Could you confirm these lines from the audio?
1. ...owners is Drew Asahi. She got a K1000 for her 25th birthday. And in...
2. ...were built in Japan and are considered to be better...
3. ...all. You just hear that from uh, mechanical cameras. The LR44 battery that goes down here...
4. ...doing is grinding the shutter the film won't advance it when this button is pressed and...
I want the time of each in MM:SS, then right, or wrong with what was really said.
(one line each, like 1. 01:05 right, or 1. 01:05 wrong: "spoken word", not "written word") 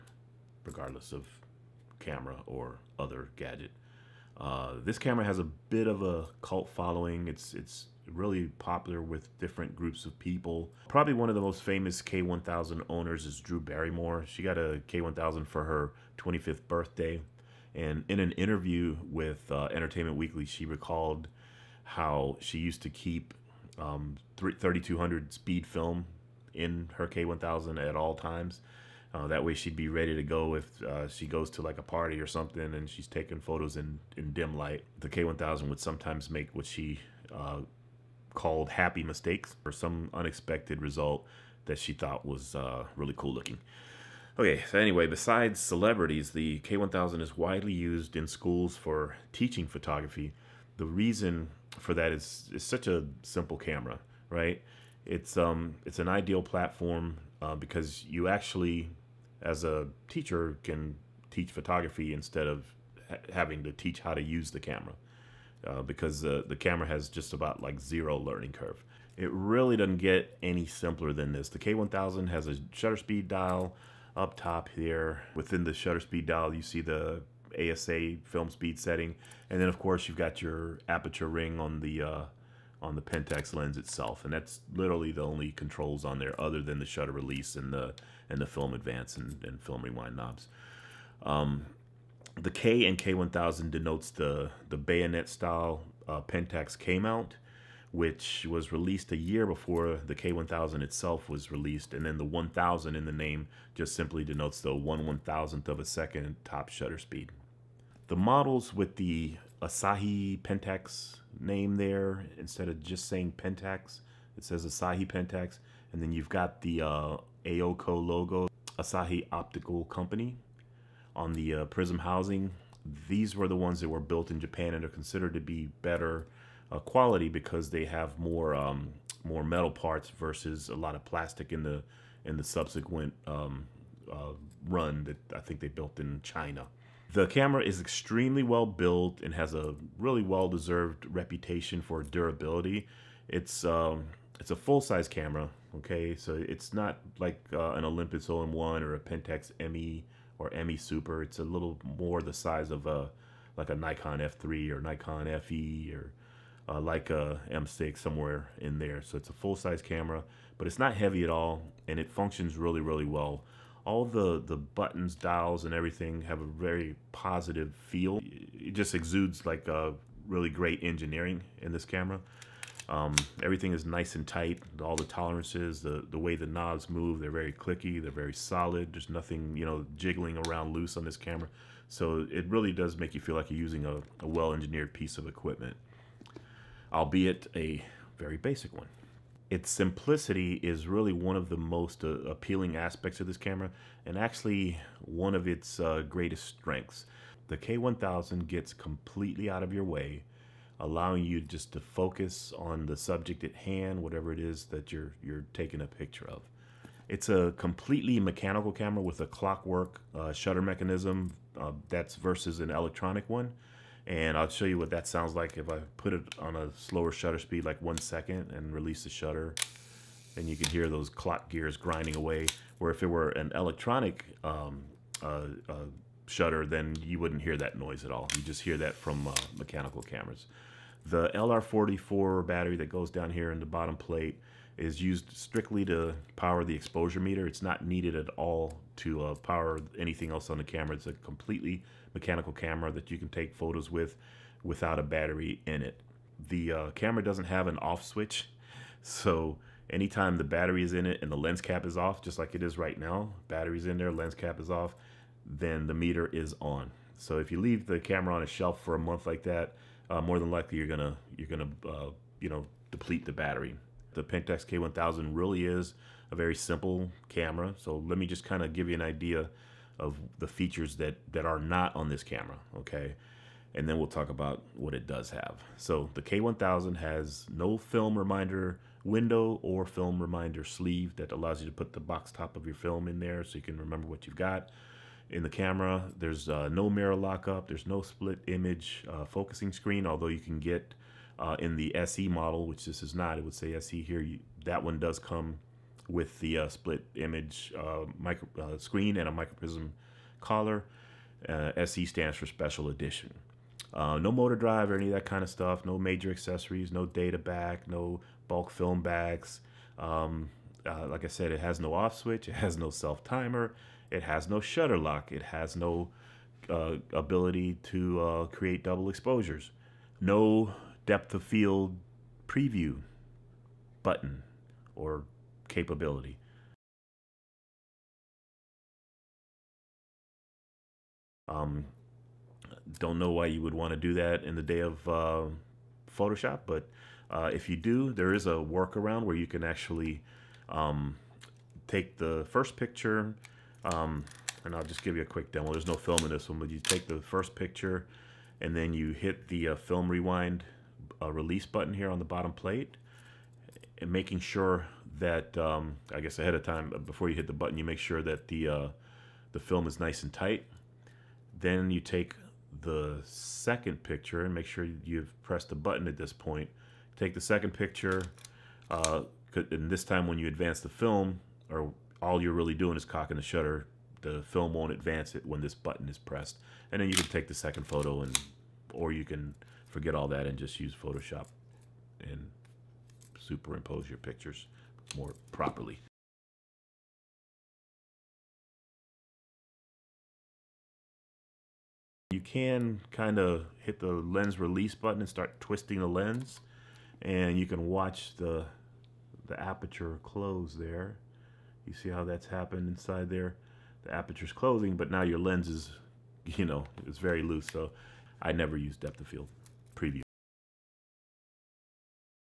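1. 00:12 wrong: "Barrymore", not "Asahi"
2. 02:03 right
3. 03:48 right
4. 06:12 wrong: "cocking", not "grinding".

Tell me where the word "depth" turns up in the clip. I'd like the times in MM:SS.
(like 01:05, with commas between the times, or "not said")
05:21, 06:48.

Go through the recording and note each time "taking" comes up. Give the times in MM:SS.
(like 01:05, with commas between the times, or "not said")
00:33, 03:25.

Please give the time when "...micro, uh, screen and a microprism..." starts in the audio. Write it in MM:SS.
04:58.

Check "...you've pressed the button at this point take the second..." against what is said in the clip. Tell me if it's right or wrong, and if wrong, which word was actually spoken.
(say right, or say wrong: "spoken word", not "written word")
right.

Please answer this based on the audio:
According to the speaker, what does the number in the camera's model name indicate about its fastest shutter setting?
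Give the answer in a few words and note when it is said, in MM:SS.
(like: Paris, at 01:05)
1/1000th of a second, at 01:44.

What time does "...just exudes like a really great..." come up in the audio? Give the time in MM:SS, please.
02:48.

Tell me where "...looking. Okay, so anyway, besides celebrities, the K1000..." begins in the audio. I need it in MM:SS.
00:43.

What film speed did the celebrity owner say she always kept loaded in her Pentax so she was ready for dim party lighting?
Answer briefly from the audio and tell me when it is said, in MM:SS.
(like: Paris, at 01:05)
3200, at 00:24.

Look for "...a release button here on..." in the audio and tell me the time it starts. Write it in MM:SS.
05:51.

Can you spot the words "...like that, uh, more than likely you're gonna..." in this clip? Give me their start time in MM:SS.
04:19.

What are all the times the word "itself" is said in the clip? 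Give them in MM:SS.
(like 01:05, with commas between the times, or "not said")
01:23, 01:40.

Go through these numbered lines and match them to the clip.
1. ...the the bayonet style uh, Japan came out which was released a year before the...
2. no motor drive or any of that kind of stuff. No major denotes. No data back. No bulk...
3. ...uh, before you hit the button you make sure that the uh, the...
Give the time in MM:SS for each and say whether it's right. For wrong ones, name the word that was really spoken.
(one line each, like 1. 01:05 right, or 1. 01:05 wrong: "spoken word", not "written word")
1. 01:34 wrong: "Pentax", not "Japan"
2. 05:03 wrong: "accessories", not "denotes"
3. 05:56 right.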